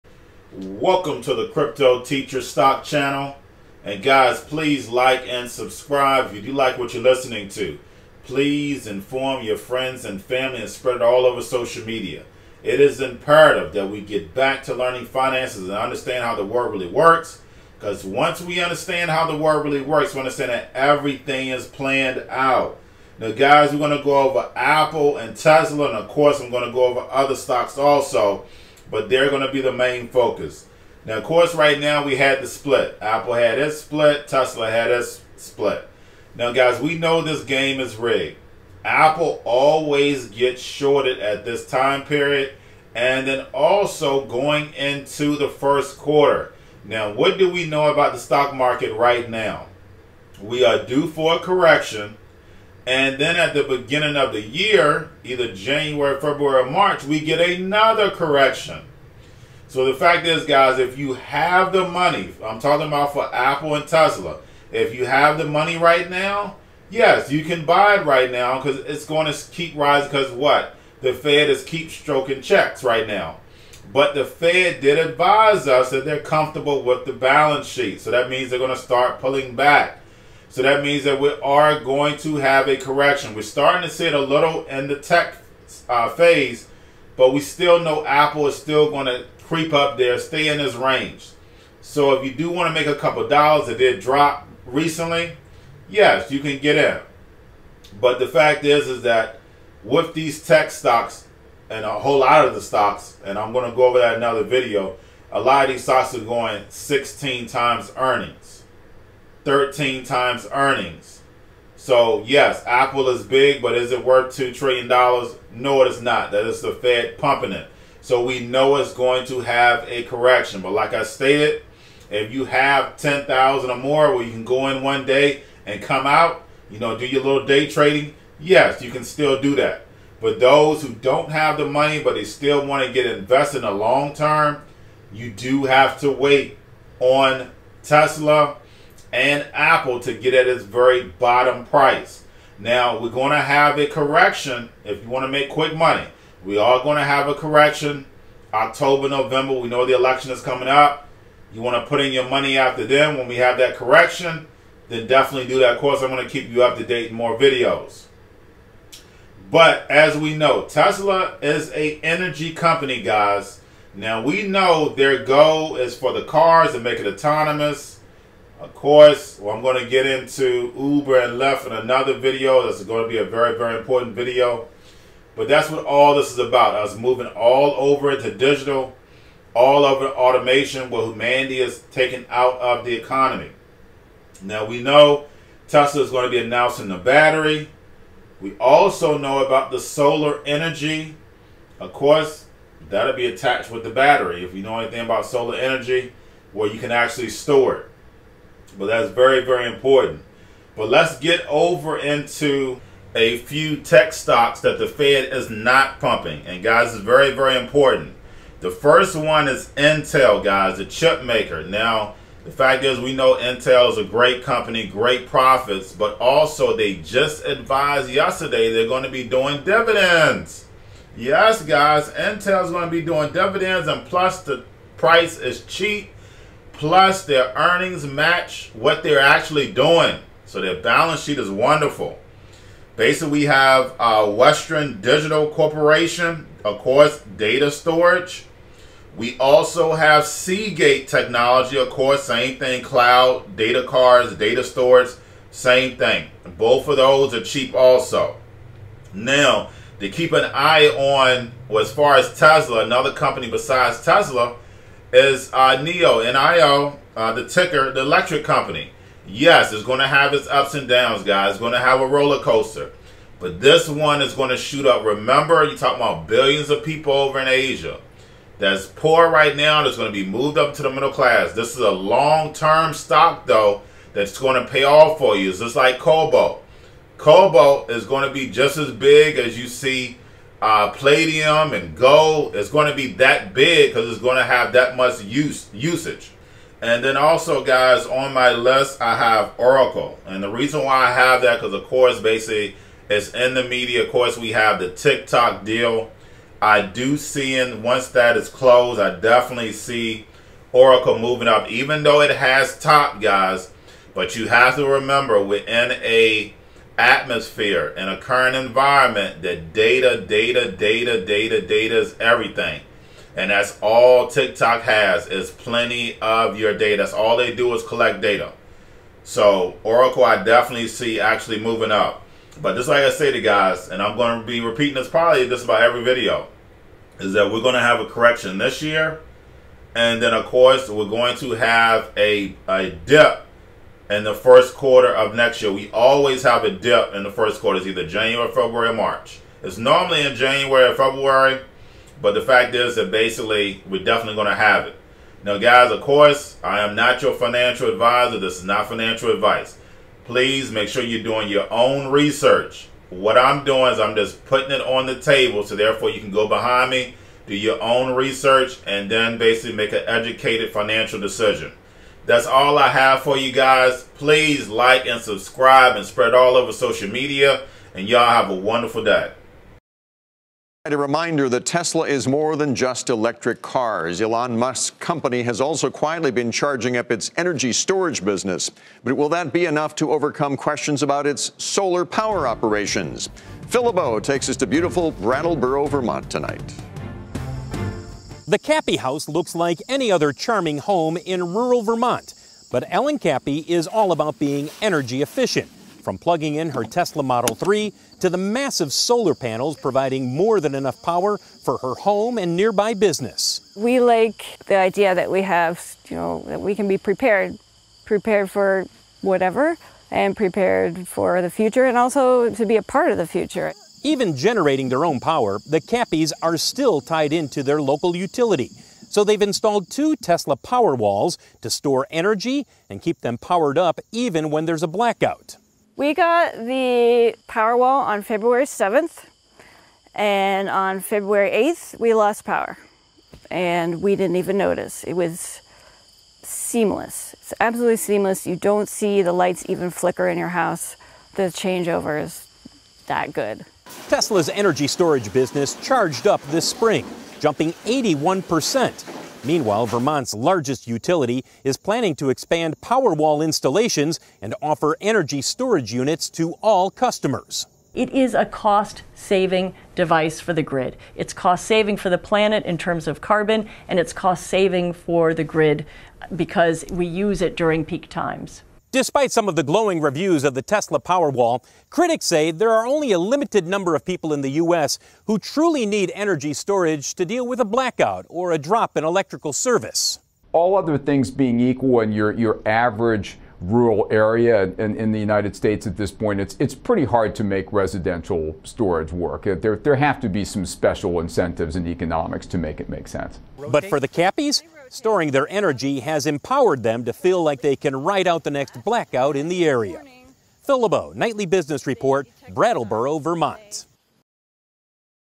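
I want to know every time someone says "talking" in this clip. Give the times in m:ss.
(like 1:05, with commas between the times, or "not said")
1:02, 4:25.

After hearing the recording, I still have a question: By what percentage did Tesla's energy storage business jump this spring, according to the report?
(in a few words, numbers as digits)
81%.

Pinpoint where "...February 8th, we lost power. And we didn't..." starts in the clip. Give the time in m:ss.
7:11.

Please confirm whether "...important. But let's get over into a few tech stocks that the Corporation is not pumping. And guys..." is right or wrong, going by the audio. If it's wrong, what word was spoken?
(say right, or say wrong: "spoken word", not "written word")
wrong: "Fed", not "Corporation".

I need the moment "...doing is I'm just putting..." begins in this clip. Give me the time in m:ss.
5:53.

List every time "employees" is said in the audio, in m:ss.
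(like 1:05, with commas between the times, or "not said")
not said.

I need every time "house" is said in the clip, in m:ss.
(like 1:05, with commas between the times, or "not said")
6:28, 7:20.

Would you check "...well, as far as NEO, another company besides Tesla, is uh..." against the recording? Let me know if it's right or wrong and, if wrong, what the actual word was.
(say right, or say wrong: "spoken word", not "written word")
wrong: "Tesla", not "NEO".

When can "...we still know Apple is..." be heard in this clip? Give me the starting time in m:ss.
1:27.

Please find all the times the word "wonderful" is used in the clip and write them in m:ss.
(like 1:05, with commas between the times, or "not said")
3:51, 6:08.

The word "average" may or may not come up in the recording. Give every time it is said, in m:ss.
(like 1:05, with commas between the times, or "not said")
8:02.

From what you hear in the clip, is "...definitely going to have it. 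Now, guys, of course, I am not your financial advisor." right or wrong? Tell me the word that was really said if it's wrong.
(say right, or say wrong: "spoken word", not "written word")
right.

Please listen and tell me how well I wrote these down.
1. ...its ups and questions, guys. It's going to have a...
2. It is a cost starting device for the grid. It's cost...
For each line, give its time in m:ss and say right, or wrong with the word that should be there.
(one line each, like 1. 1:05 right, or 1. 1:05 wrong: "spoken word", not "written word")
1. 4:20 wrong: "downs", not "questions"
2. 7:37 wrong: "saving", not "starting".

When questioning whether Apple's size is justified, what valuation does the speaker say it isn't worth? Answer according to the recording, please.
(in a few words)
$2 trillion.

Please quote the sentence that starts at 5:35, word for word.
We always have a dip in the first quarter.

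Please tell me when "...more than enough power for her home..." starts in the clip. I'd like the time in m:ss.
6:40.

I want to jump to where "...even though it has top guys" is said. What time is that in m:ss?
5:01.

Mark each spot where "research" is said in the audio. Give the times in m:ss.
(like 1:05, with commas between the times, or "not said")
5:52, 5:58.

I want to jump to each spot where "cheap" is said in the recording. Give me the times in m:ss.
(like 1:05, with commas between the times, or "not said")
3:45, 4:07.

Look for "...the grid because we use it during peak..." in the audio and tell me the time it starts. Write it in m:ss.
7:45.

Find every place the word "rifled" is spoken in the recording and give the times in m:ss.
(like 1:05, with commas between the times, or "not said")
not said.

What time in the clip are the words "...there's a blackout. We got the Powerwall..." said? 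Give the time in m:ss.
7:04.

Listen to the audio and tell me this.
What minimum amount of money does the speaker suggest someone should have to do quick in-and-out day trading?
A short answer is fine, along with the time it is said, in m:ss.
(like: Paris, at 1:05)
10,000, at 2:02.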